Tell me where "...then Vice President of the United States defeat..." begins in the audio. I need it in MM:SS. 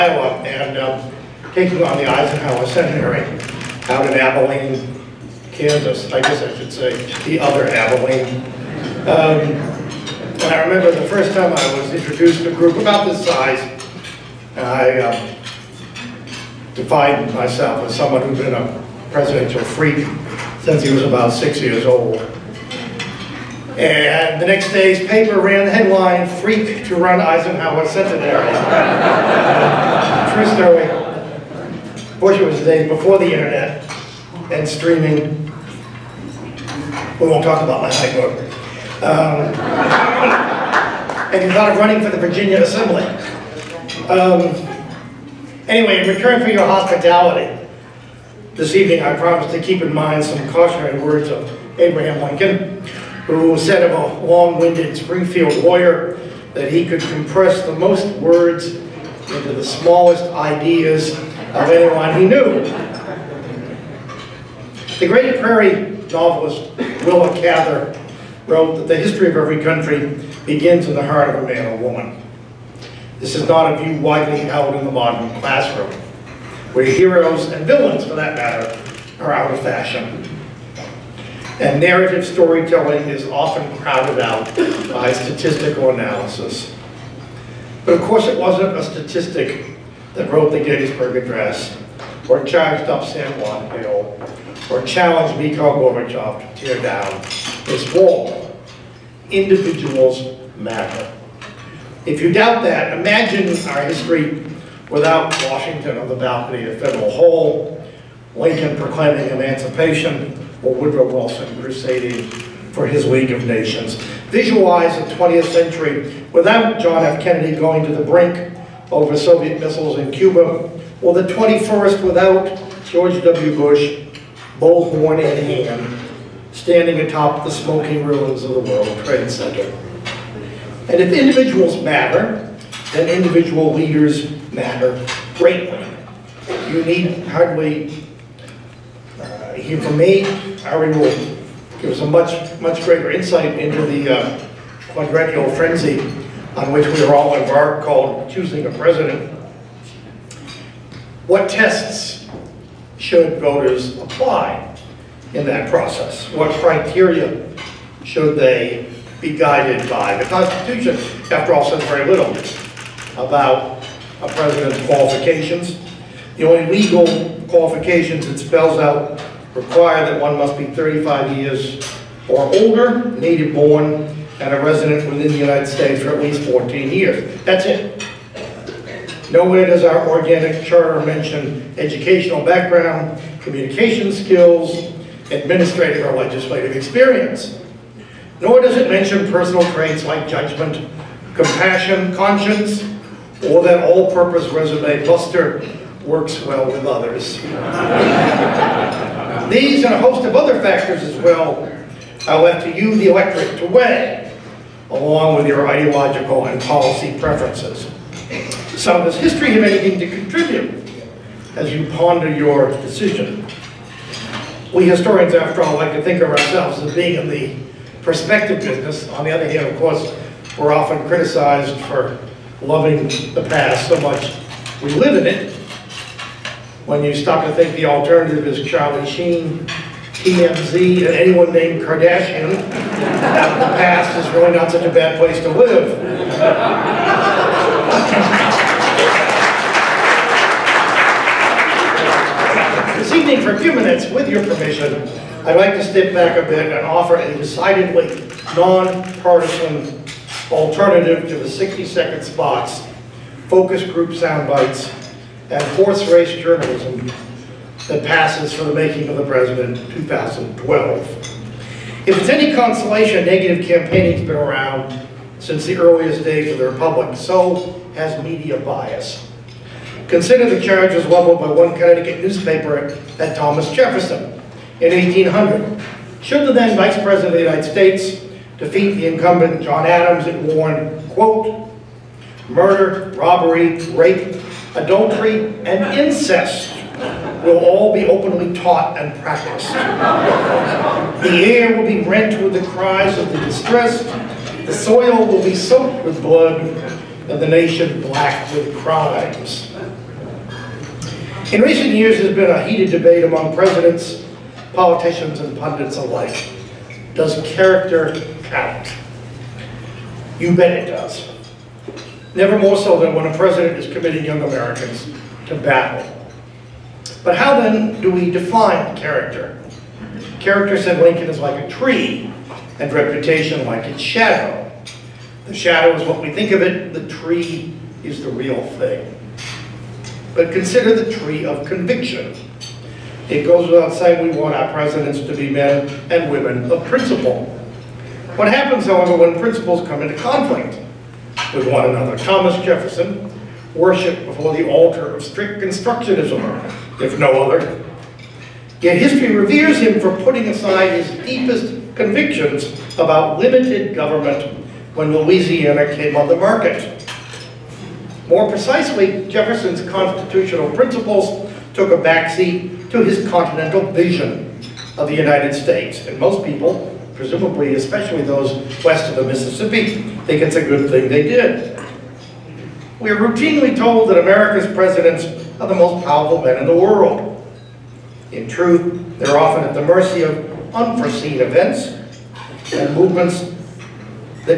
04:36.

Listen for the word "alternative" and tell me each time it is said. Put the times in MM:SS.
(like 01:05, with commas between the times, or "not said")
03:47, 04:10.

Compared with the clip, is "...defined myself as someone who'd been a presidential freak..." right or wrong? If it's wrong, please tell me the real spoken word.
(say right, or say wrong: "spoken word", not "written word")
right.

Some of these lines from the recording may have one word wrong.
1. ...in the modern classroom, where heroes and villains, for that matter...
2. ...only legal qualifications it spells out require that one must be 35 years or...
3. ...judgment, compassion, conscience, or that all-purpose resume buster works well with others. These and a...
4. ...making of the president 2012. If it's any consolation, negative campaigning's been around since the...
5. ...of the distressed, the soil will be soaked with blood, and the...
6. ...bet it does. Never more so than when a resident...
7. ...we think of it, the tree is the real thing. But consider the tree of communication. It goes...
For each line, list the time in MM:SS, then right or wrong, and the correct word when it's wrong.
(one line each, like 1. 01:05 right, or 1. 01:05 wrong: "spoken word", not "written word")
1. 01:14 right
2. 02:46 right
3. 03:10 right
4. 04:18 right
5. 04:53 right
6. 05:10 wrong: "president", not "resident"
7. 05:26 wrong: "conviction", not "communication".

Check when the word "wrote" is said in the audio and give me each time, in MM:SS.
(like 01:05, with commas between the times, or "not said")
01:08, 01:30.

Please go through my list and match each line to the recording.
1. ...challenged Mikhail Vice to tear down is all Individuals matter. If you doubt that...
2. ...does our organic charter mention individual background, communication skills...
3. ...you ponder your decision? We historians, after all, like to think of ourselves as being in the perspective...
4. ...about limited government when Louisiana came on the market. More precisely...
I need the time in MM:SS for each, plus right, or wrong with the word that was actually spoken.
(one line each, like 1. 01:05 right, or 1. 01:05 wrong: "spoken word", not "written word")
1. 01:34 wrong: "Gorbachev", not "Vice"
2. 02:59 wrong: "educational", not "individual"
3. 03:31 right
4. 05:52 right.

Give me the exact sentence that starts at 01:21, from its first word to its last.
And narrative storytelling is often crowded out by statistical analysis.